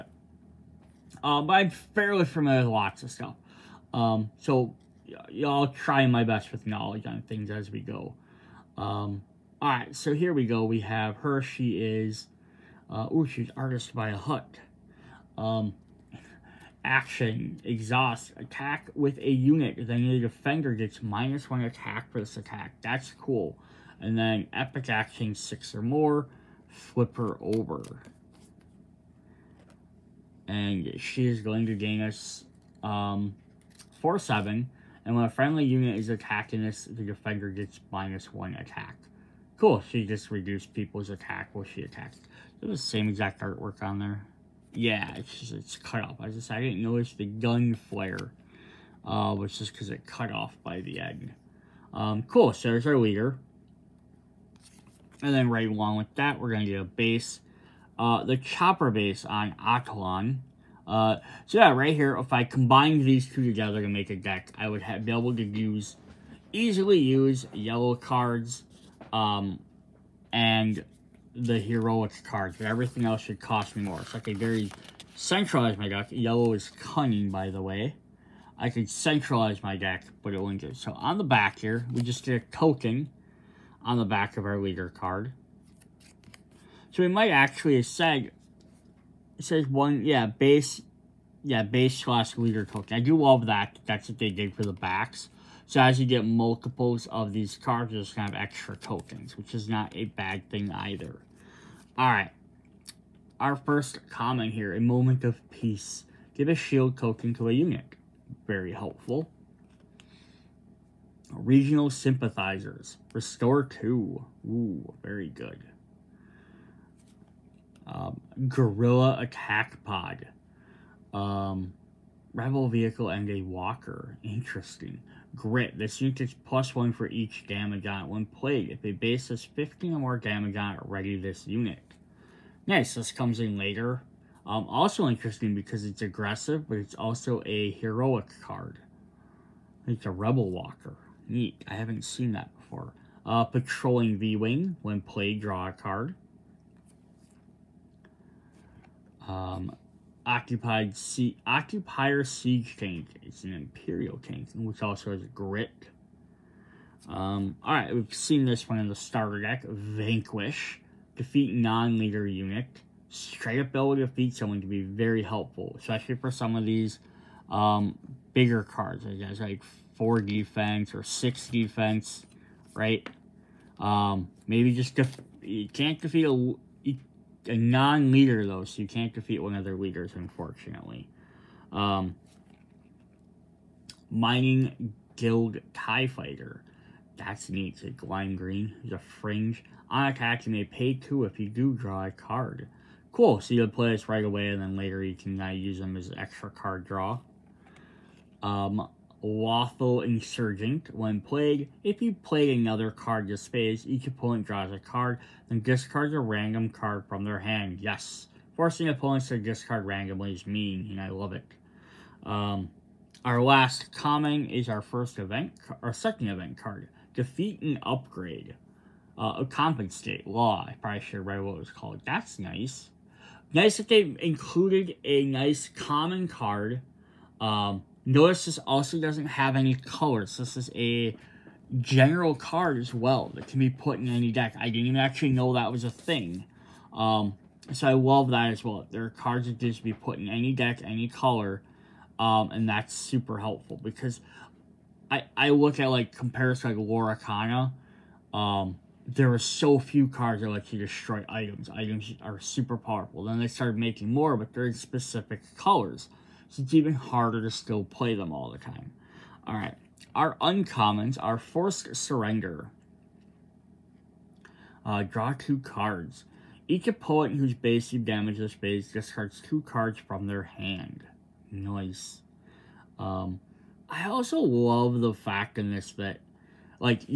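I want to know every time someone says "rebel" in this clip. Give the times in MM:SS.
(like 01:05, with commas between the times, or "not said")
02:02, 02:20.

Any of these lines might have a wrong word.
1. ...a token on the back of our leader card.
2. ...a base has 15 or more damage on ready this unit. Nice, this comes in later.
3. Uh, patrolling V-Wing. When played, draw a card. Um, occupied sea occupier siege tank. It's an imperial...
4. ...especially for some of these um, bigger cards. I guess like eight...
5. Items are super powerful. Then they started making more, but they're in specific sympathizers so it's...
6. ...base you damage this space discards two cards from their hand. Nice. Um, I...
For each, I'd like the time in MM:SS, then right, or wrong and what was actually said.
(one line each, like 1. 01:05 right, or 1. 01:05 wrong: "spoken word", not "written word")
1. 01:22 right
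2. 02:08 right
3. 02:23 right
4. 02:45 wrong: "four", not "eight"
5. 04:11 wrong: "colors", not "sympathizers"
6. 04:27 right.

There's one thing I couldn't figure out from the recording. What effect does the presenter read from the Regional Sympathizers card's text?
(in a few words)
Restore 2.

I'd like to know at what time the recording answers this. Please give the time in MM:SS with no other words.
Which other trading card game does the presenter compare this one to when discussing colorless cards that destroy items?
04:06.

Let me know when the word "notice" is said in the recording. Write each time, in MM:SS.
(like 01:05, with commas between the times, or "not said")
00:46, 03:48.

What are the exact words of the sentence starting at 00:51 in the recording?
Um, cool, so there's our leader.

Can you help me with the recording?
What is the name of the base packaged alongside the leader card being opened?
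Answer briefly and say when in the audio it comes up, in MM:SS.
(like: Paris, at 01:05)
Chopper Base on Atollon, at 00:58.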